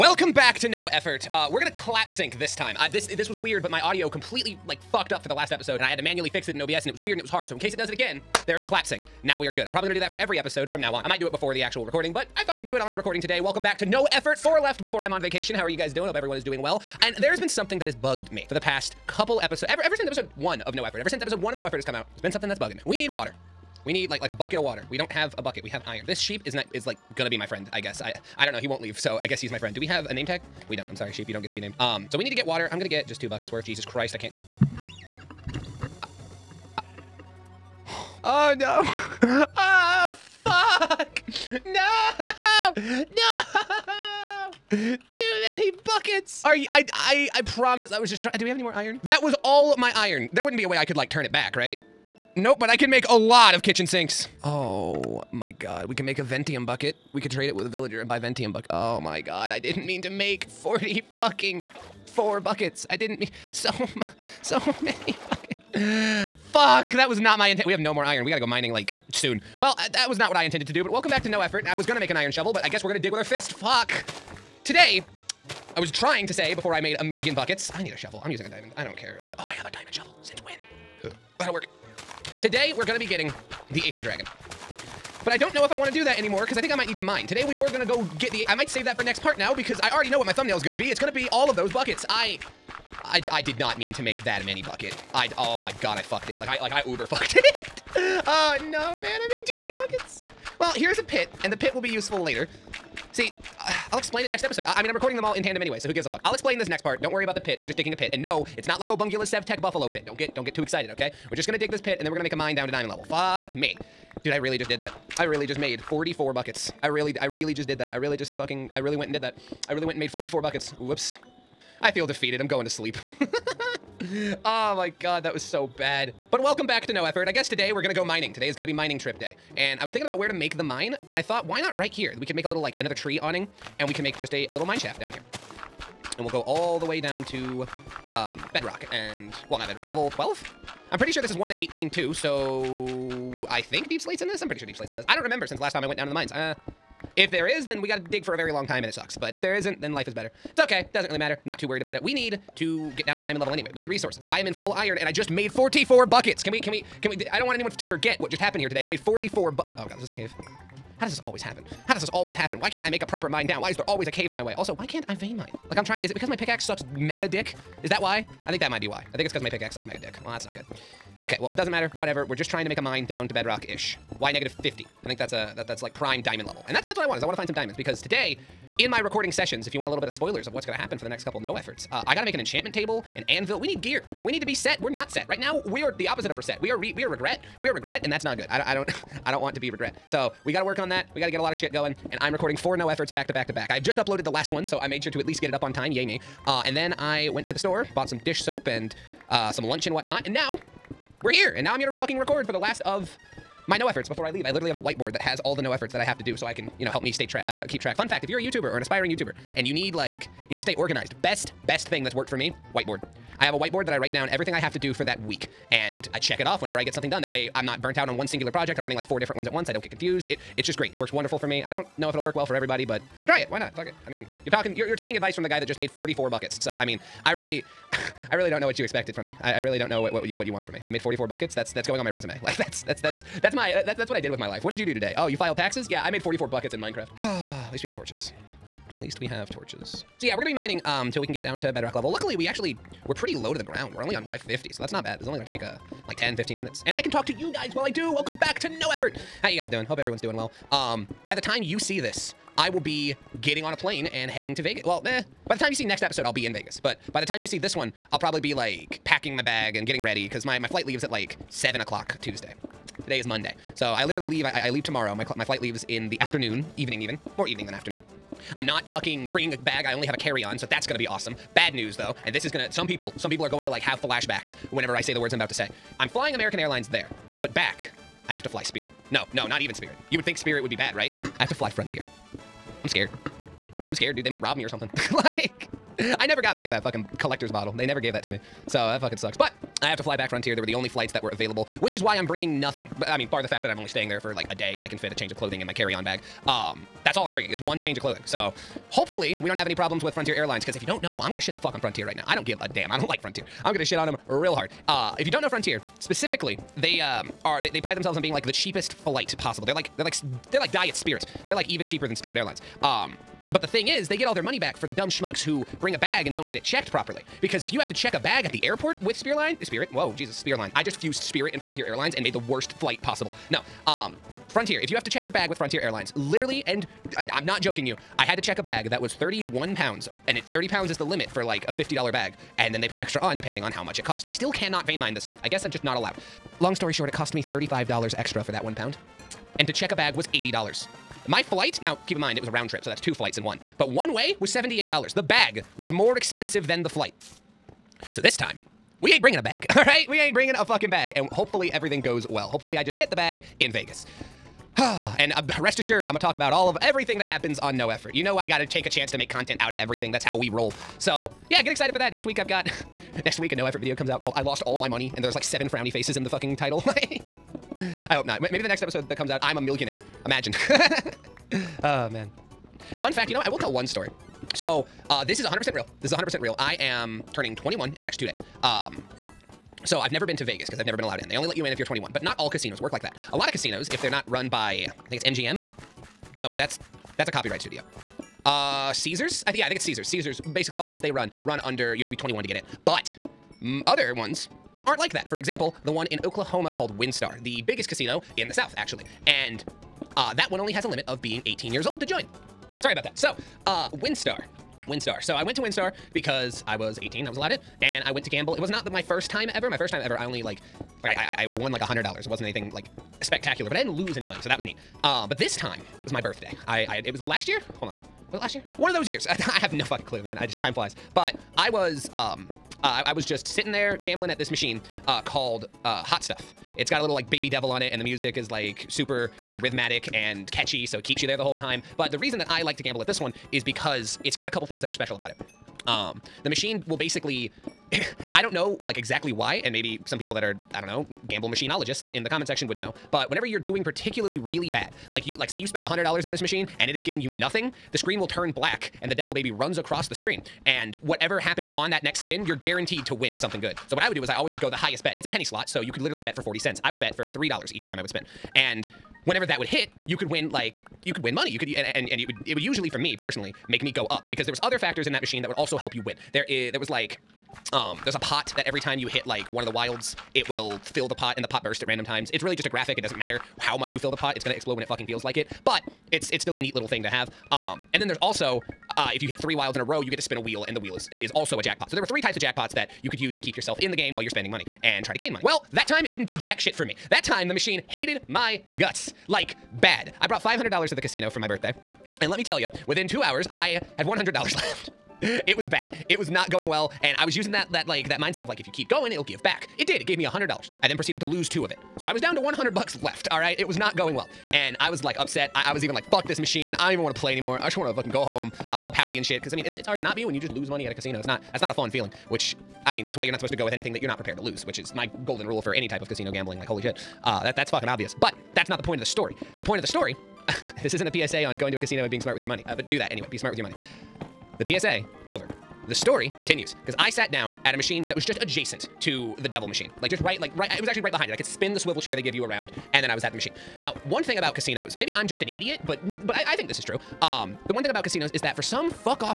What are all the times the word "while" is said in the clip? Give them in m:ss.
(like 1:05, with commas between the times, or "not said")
4:07, 8:04.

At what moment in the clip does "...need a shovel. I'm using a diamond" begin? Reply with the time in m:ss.
1:17.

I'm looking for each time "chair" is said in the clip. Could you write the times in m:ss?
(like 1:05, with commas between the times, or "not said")
8:51.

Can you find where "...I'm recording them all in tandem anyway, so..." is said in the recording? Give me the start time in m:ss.
1:44.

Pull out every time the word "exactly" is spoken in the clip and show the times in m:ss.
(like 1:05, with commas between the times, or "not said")
7:18.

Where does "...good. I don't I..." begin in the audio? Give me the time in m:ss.
3:08.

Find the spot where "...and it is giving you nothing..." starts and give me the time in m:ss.
7:26.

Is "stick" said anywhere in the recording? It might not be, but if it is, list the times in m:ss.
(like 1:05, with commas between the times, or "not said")
not said.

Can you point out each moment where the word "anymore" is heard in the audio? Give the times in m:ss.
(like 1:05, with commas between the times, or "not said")
1:26, 8:27.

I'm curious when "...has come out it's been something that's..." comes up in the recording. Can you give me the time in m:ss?
0:21.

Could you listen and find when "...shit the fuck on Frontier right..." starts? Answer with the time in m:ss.
5:01.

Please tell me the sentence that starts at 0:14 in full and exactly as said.
Four left before I'm on vacation.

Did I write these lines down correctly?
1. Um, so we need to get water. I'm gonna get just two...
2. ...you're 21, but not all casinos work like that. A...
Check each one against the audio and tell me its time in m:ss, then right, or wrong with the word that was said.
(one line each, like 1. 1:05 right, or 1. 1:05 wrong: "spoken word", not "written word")
1. 0:31 right
2. 6:21 right.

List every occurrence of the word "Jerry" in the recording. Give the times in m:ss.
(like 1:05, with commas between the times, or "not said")
not said.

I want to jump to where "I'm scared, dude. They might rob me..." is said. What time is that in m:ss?
4:43.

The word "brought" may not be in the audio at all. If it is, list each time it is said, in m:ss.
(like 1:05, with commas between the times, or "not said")
8:10.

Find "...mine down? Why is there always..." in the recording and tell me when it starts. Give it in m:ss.
2:43.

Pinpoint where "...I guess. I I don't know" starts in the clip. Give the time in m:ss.
0:27.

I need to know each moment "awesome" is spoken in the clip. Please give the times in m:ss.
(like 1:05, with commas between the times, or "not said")
4:31.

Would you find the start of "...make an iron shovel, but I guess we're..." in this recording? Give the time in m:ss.
1:11.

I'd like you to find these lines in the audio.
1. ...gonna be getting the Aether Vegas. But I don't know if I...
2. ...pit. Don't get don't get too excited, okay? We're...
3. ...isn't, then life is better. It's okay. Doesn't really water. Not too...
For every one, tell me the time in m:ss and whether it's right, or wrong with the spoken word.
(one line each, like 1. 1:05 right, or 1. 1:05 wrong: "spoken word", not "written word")
1. 1:22 wrong: "Dragon", not "Vegas"
2. 1:49 right
3. 2:29 wrong: "matter", not "water".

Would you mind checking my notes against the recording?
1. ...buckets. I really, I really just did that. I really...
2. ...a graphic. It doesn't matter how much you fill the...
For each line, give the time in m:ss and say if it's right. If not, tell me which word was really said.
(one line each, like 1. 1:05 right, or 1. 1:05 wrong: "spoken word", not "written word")
1. 1:56 right
2. 7:52 right.